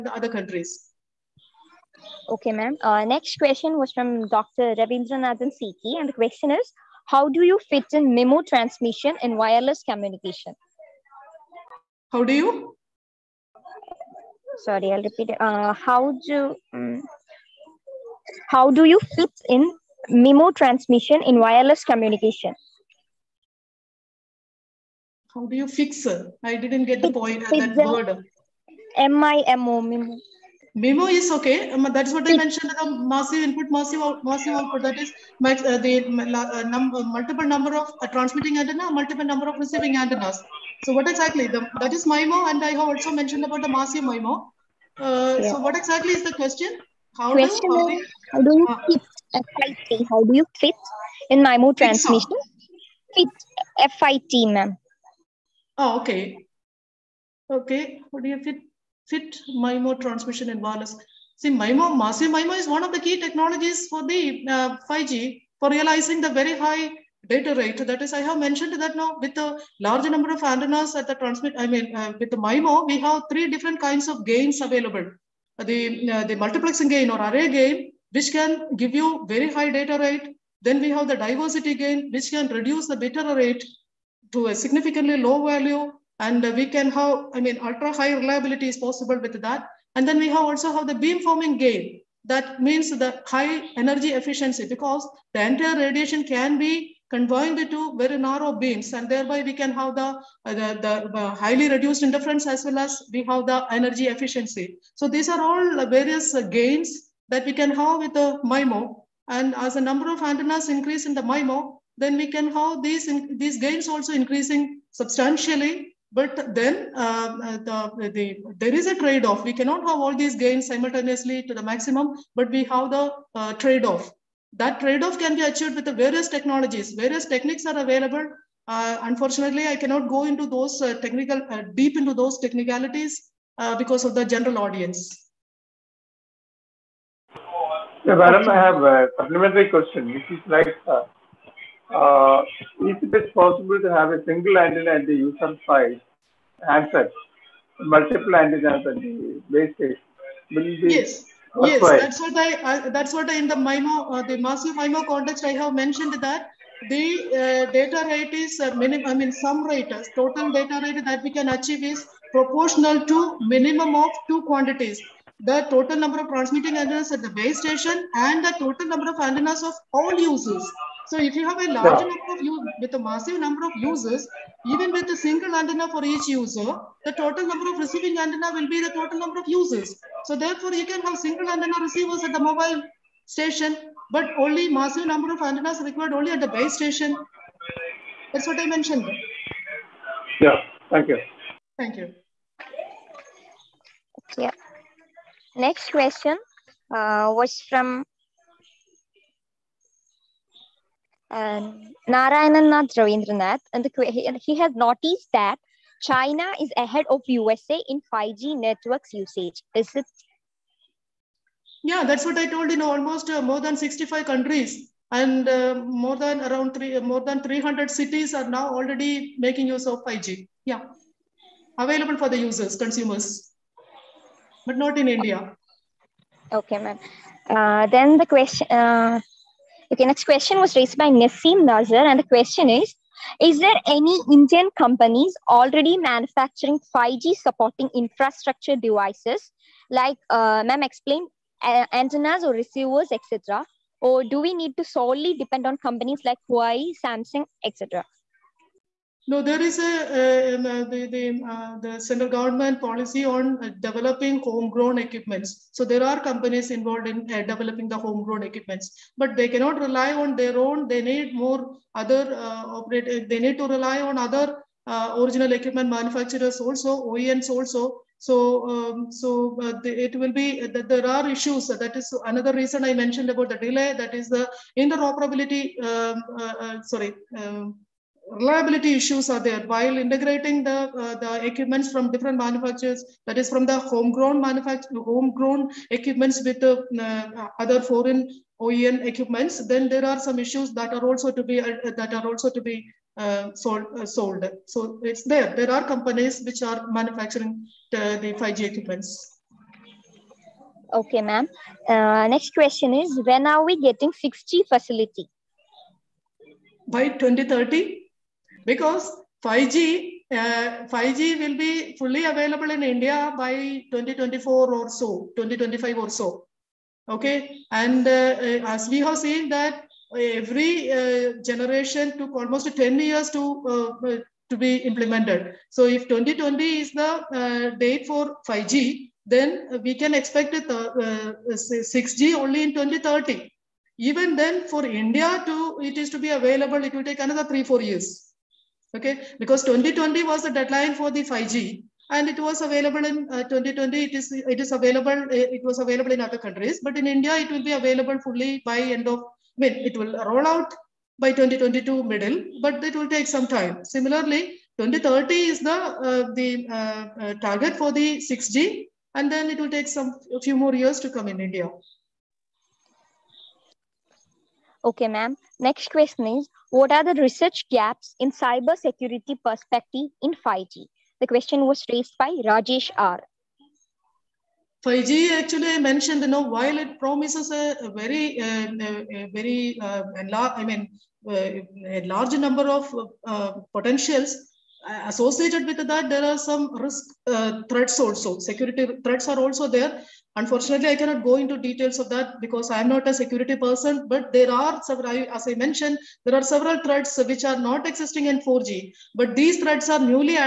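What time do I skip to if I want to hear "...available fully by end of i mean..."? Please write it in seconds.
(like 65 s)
347 s.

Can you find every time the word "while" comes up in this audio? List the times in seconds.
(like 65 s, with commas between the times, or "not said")
279 s, 376 s.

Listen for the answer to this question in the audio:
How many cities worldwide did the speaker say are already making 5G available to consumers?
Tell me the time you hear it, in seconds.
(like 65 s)
217 s.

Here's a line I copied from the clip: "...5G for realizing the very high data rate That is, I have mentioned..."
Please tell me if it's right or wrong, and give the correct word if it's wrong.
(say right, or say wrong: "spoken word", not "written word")
right.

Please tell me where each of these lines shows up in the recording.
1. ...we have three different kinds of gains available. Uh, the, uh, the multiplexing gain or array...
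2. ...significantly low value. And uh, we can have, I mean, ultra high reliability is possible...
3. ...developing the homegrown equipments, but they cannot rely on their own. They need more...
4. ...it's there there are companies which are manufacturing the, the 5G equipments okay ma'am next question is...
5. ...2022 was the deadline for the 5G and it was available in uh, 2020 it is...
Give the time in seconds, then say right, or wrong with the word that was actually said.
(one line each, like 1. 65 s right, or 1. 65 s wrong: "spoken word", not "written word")
1. 72 s right
2. 84 s right
3. 257 s right
4. 295 s right
5. 339 s wrong: "2020", not "2022".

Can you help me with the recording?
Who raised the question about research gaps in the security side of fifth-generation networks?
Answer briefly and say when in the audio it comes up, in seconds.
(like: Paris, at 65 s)
Rajesh R., at 372 s.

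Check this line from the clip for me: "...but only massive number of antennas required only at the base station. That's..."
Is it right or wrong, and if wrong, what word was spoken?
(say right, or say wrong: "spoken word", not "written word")
right.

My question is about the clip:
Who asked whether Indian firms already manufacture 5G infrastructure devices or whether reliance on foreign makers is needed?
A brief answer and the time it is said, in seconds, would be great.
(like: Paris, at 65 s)
Nassim Nazar, at 231 s.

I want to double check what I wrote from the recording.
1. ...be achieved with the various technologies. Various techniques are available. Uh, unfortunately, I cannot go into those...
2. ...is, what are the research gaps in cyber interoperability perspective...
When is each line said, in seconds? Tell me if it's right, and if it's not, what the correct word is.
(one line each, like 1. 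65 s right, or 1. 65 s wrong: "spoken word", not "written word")
1. 125 s right
2. 366 s wrong: "security", not "interoperability".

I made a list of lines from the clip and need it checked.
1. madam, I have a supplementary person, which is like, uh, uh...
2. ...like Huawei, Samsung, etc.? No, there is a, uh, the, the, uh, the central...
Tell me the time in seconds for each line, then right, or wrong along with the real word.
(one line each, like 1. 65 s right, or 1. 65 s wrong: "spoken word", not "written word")
1. 138 s wrong: "question", not "person"
2. 246 s right.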